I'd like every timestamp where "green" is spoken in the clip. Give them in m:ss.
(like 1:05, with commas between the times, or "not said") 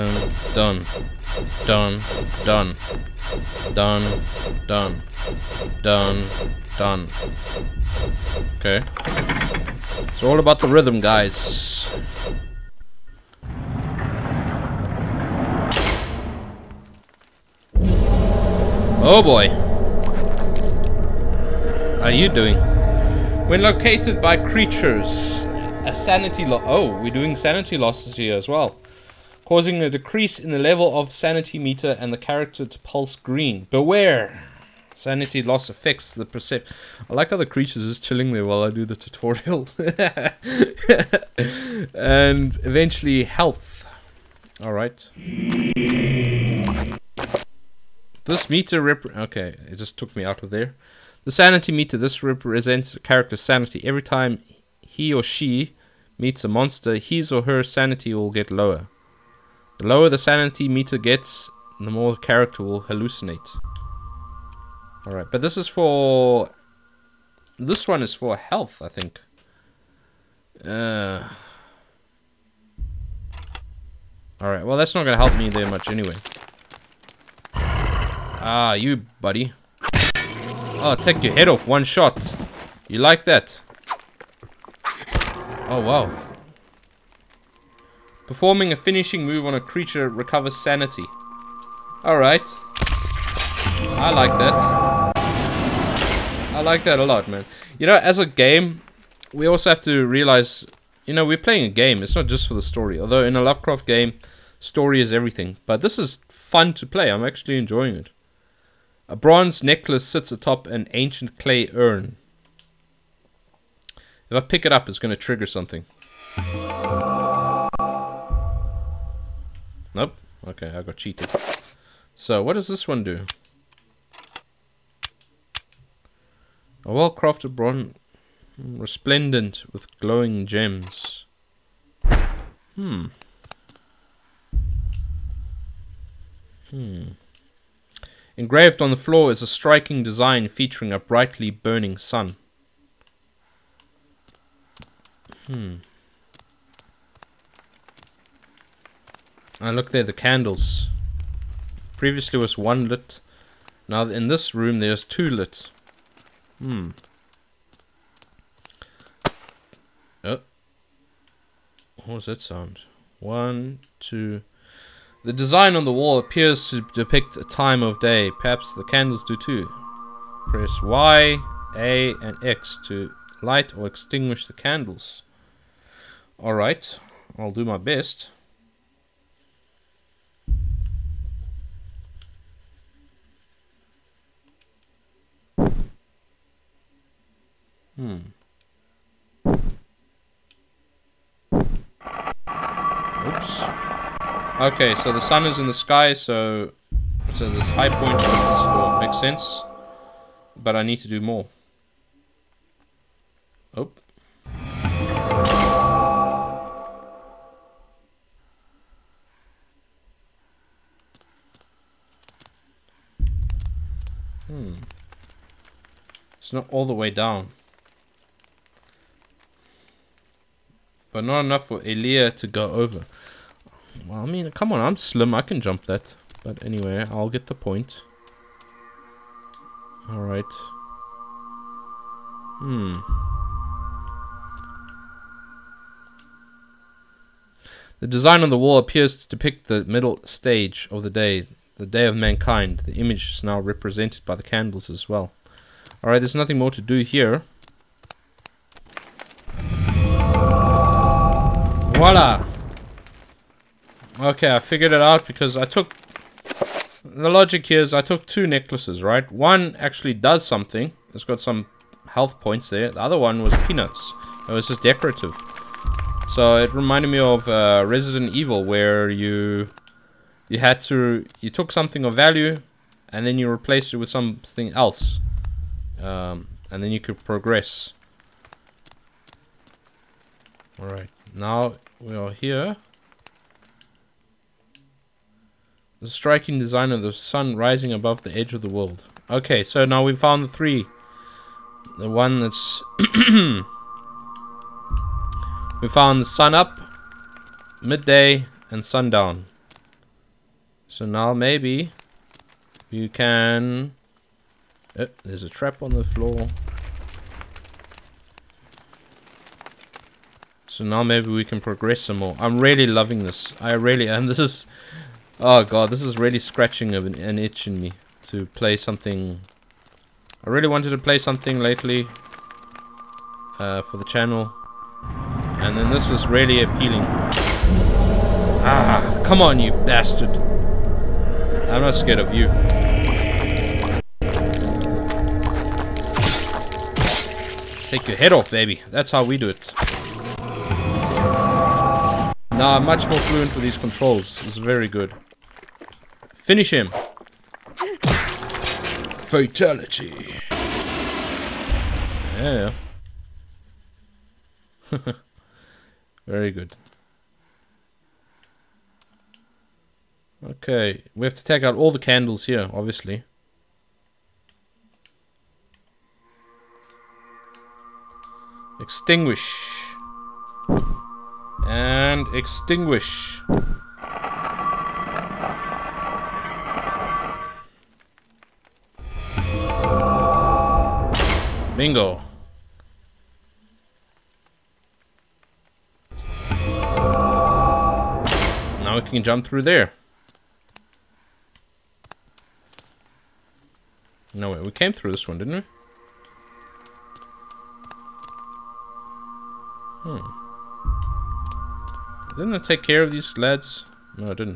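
0:33.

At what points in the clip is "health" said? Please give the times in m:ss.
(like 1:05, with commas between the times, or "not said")
0:43, 1:08, 4:22.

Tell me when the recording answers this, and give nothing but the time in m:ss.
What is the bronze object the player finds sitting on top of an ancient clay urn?
1:49.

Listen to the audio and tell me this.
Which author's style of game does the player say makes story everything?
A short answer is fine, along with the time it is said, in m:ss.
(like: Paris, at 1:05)
Lovecraft, at 1:43.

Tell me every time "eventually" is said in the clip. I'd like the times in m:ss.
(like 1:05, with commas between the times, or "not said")
0:42.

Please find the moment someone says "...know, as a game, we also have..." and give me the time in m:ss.
1:37.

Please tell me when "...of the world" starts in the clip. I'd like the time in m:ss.
4:48.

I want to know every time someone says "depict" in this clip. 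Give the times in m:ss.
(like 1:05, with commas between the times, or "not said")
2:46, 3:59.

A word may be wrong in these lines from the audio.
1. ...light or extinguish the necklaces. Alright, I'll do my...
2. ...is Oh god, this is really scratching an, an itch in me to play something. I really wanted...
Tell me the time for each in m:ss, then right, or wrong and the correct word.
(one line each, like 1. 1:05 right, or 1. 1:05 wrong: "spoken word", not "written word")
1. 2:53 wrong: "candles", not "necklaces"
2. 5:14 right.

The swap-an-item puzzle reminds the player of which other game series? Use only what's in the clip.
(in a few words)
Resident Evil.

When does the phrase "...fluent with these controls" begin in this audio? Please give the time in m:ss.
5:43.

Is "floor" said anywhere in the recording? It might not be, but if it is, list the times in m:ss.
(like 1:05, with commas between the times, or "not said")
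2:18, 5:06.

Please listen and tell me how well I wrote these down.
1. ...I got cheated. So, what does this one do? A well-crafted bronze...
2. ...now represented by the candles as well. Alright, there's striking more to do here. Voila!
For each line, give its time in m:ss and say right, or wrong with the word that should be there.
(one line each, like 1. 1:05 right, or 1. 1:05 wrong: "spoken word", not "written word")
1. 2:00 right
2. 4:03 wrong: "nothing", not "striking".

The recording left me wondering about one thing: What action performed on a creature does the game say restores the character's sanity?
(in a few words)
finishing move.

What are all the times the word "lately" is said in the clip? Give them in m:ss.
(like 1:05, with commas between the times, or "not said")
5:21.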